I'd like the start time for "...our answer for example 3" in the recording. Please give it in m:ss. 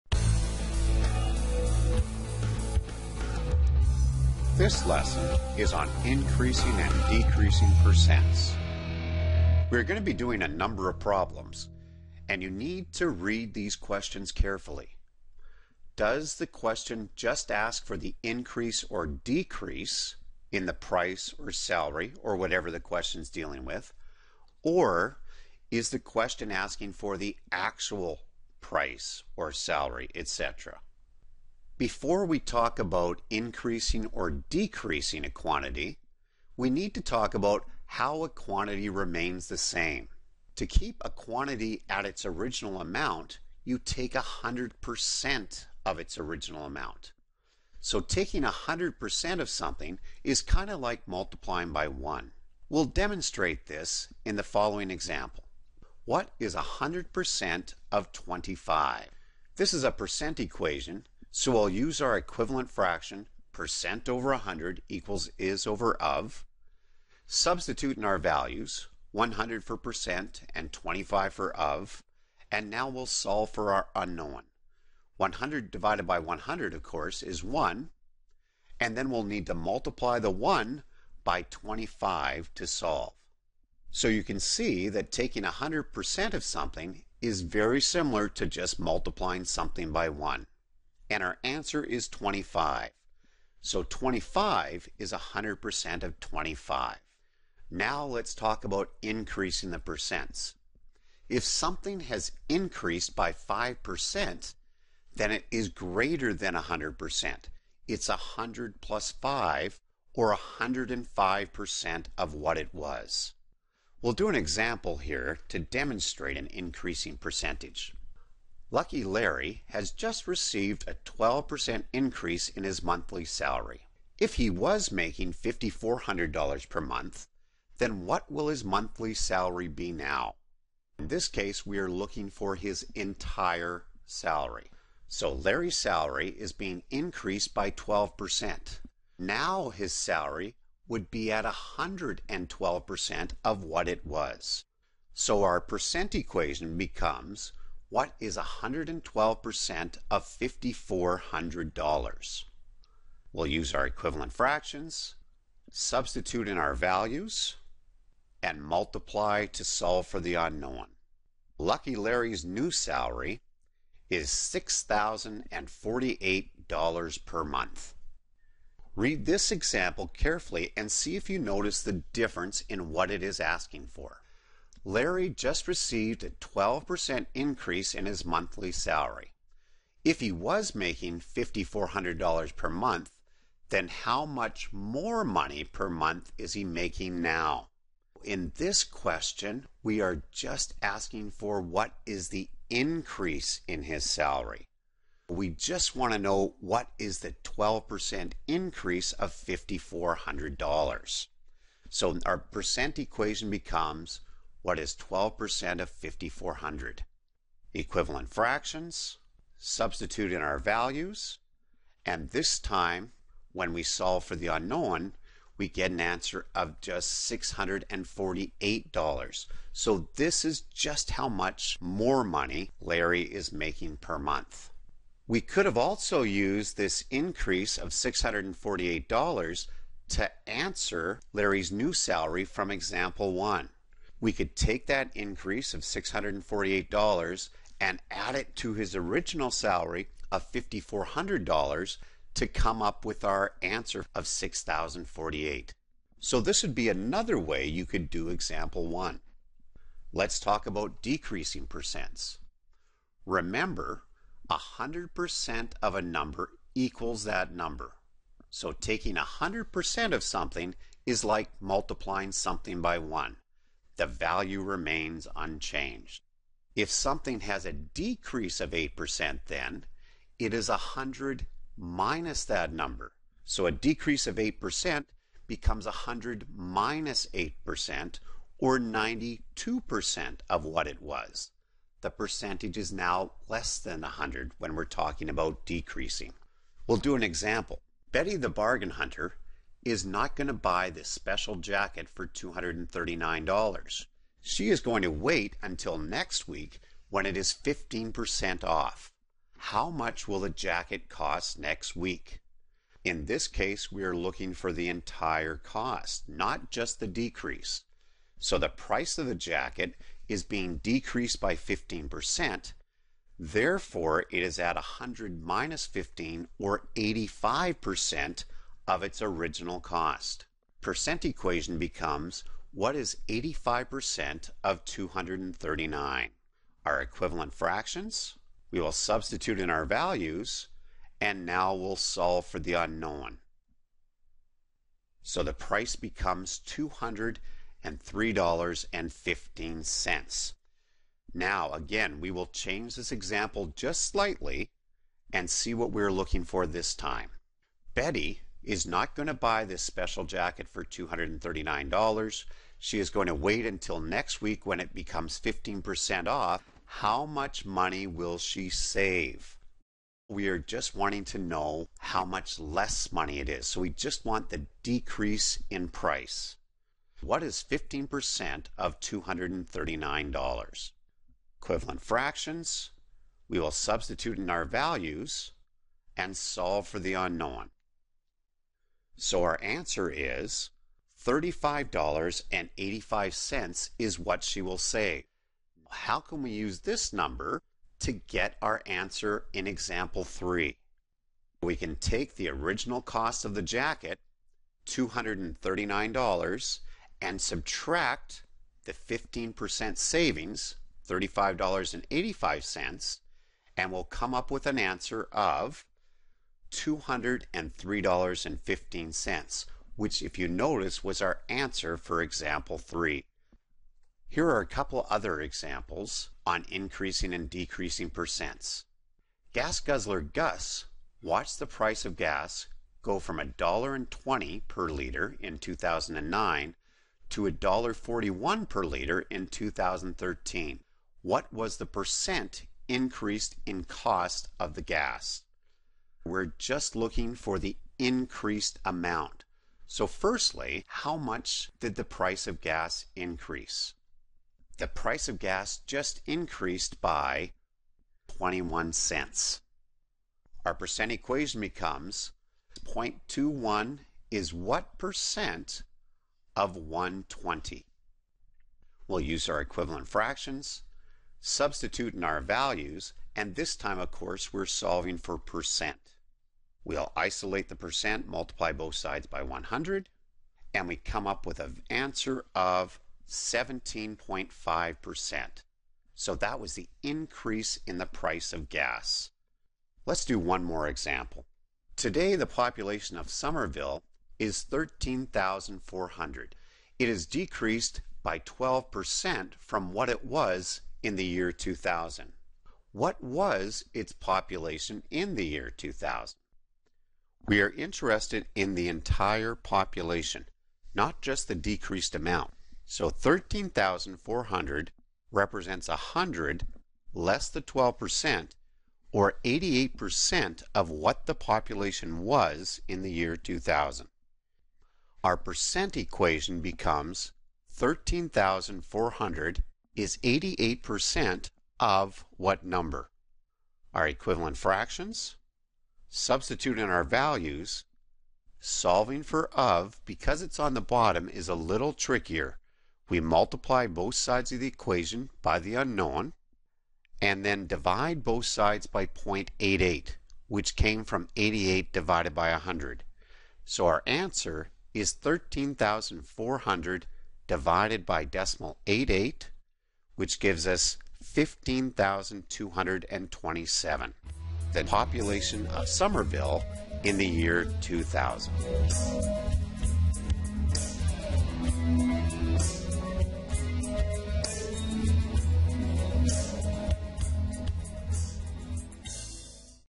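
6:51.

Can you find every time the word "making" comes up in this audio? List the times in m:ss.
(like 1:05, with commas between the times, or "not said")
2:04, 3:00, 3:06, 3:43.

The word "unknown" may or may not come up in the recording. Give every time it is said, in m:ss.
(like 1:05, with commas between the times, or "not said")
1:13, 2:40, 3:34, 5:32, 6:17, 8:55.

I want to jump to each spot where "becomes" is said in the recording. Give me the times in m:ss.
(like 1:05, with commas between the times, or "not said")
2:26, 3:23, 4:35, 5:21, 5:35, 5:54, 7:31, 8:36.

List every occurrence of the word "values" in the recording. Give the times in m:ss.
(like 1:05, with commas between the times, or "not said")
1:08, 2:36, 3:30, 4:24, 5:29, 6:14, 7:42, 8:47.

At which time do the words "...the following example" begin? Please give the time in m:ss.
0:54.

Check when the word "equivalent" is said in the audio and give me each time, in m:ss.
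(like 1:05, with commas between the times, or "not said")
1:02, 2:33, 3:27, 5:27, 6:11, 7:39, 8:44.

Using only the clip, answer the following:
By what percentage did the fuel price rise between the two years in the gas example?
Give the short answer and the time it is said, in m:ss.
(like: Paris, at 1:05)
17.5%, at 7:53.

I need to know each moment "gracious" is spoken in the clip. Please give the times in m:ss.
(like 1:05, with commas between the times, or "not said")
not said.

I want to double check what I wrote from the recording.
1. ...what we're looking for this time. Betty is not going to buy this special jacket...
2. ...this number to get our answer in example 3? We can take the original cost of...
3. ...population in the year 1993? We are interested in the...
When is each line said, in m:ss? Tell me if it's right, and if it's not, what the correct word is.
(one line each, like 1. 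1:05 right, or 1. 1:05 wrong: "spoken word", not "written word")
1. 5:45 right
2. 6:26 right
3. 8:14 wrong: "2000", not "1993".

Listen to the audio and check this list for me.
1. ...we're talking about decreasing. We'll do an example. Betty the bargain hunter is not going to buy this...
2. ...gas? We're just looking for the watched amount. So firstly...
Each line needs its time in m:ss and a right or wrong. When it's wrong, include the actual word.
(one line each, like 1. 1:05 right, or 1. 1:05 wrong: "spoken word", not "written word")
1. 4:44 right
2. 7:14 wrong: "increased", not "watched".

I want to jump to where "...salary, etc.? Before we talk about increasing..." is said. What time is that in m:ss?
0:29.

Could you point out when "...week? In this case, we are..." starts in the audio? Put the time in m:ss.
5:01.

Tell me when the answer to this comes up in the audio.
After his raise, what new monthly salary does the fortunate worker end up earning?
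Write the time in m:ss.
2:44.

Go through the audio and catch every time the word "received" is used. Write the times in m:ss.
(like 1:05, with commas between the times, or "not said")
2:00, 2:55.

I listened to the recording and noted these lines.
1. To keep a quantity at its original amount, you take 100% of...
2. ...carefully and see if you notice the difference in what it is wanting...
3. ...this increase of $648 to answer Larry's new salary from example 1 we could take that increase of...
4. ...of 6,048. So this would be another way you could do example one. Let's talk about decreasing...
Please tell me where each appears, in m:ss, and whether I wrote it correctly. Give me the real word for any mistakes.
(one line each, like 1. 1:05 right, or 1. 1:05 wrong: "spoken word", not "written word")
1. 0:40 right
2. 2:50 wrong: "asking", not "wanting"
3. 3:46 right
4. 4:04 right.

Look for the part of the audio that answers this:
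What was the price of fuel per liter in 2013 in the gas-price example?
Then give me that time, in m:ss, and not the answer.
7:07.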